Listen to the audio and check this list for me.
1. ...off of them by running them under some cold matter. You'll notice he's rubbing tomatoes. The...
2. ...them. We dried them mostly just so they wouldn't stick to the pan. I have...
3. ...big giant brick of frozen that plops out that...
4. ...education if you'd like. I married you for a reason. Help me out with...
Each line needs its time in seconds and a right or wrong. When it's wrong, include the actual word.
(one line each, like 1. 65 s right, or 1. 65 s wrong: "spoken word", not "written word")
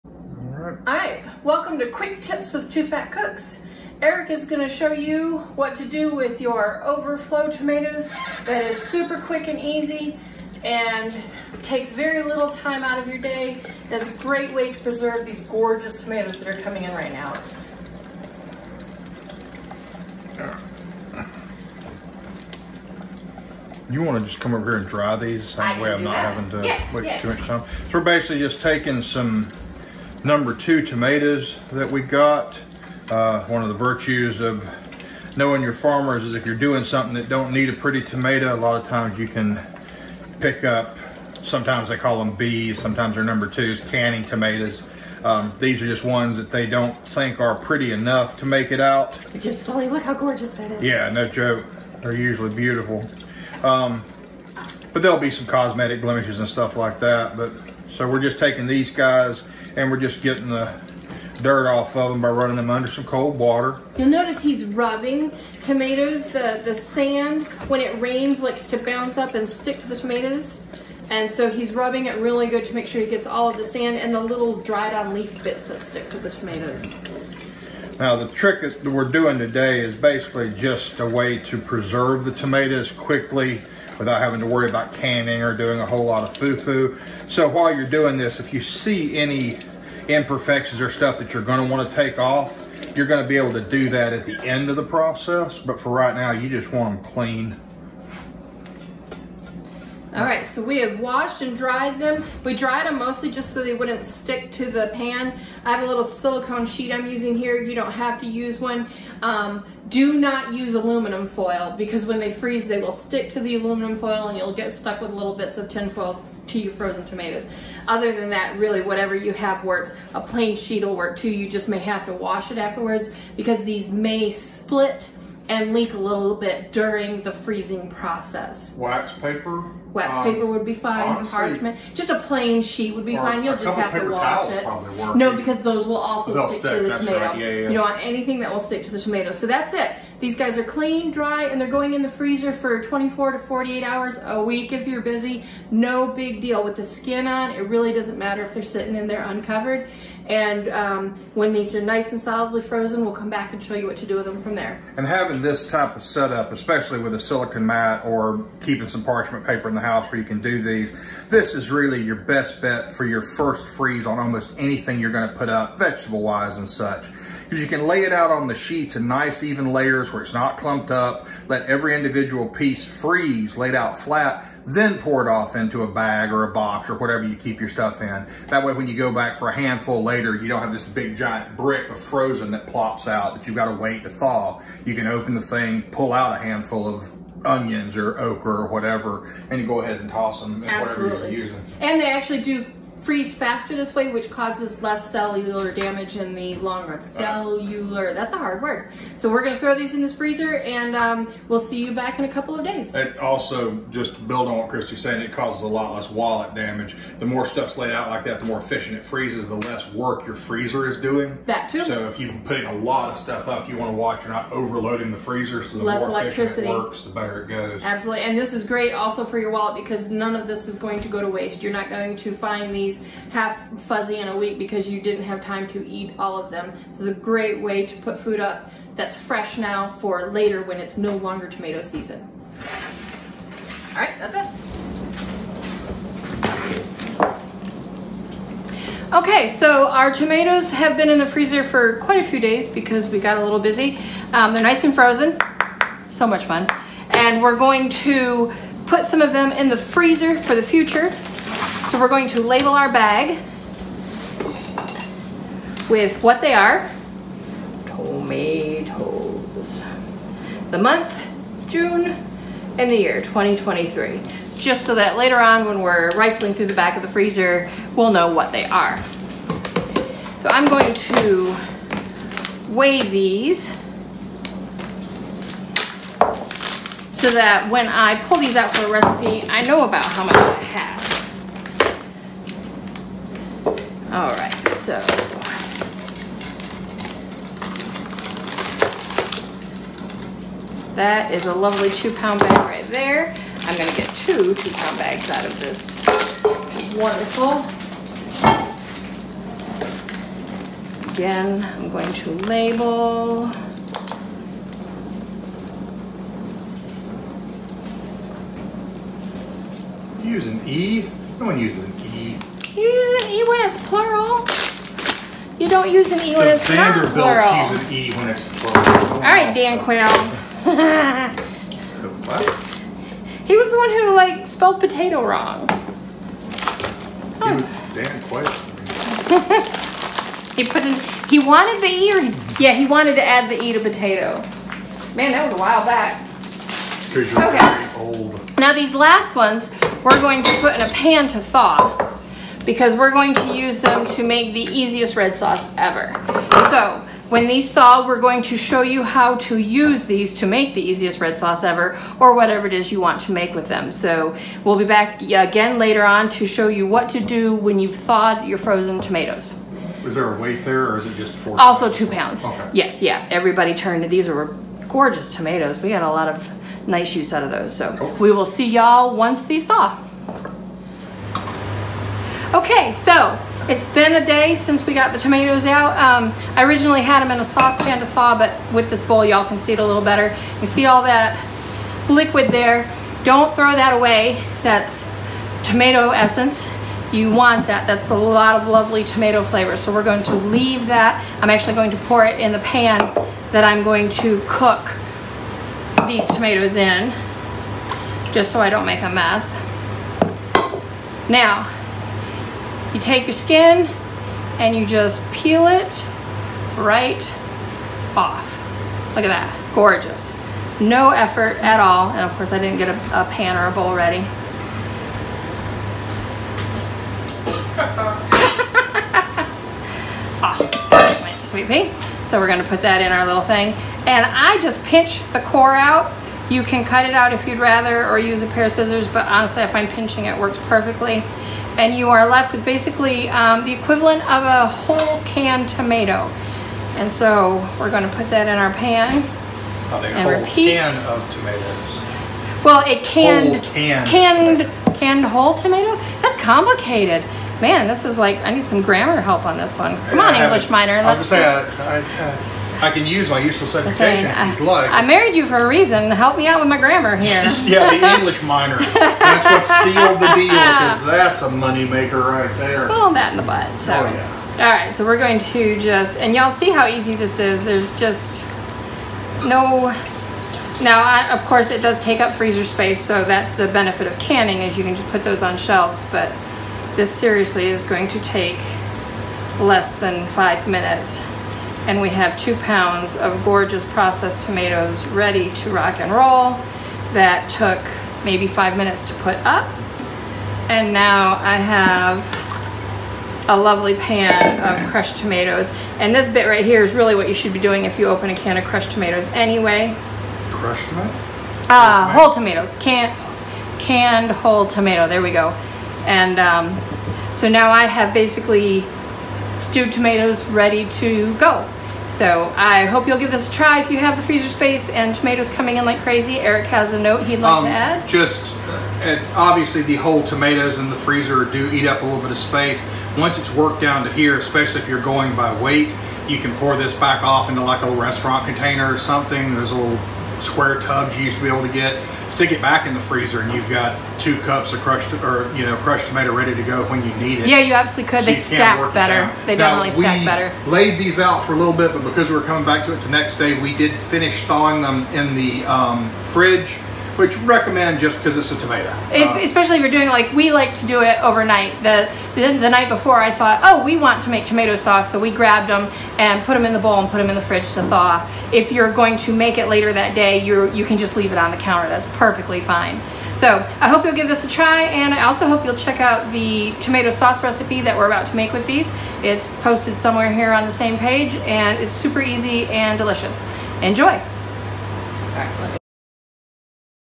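1. 61 s wrong: "water", not "matter"
2. 101 s right
3. 180 s right
4. 453 s right.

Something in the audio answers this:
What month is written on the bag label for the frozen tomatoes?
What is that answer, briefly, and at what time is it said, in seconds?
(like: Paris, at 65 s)
June, at 261 s.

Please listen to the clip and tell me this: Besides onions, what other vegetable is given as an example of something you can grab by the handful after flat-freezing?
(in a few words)
okra.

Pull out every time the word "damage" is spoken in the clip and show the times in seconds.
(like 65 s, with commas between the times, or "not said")
195 s, 206 s.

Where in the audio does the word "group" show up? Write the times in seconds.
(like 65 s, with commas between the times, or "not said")
not said.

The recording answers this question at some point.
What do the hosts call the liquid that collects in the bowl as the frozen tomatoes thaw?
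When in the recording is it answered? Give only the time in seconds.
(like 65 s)
385 s.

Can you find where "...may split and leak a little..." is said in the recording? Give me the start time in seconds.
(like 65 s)
123 s.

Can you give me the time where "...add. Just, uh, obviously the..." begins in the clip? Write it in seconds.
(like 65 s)
517 s.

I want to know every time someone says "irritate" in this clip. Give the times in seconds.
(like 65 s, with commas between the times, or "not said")
not said.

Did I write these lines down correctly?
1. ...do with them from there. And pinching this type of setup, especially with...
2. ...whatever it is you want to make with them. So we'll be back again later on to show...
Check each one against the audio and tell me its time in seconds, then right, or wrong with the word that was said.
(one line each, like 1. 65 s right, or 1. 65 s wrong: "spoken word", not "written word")
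1. 154 s wrong: "having", not "pinching"
2. 352 s right.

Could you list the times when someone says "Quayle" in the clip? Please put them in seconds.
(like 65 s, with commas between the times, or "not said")
319 s, 328 s.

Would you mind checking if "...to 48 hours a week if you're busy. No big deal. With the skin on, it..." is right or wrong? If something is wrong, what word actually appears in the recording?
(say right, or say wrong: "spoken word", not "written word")
right.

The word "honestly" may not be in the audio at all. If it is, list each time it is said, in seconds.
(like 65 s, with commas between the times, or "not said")
131 s, 429 s.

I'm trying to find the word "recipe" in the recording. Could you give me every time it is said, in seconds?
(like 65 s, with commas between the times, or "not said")
278 s, 567 s.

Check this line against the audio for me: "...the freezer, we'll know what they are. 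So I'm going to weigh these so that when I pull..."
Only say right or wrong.
right.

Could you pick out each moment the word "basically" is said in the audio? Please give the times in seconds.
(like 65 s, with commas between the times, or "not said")
28 s, 79 s, 432 s, 508 s.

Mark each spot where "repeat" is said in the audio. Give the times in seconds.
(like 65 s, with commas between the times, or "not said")
440 s.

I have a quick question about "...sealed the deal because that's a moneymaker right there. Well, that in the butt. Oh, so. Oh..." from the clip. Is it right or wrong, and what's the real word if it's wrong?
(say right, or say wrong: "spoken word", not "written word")
right.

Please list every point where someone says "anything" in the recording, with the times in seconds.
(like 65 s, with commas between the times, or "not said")
137 s, 164 s.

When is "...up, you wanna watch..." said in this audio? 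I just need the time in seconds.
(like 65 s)
213 s.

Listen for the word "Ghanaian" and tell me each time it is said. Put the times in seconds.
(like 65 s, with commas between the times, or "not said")
not said.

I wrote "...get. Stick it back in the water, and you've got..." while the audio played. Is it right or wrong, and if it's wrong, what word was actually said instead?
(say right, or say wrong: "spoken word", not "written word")
wrong: "freezer", not "water".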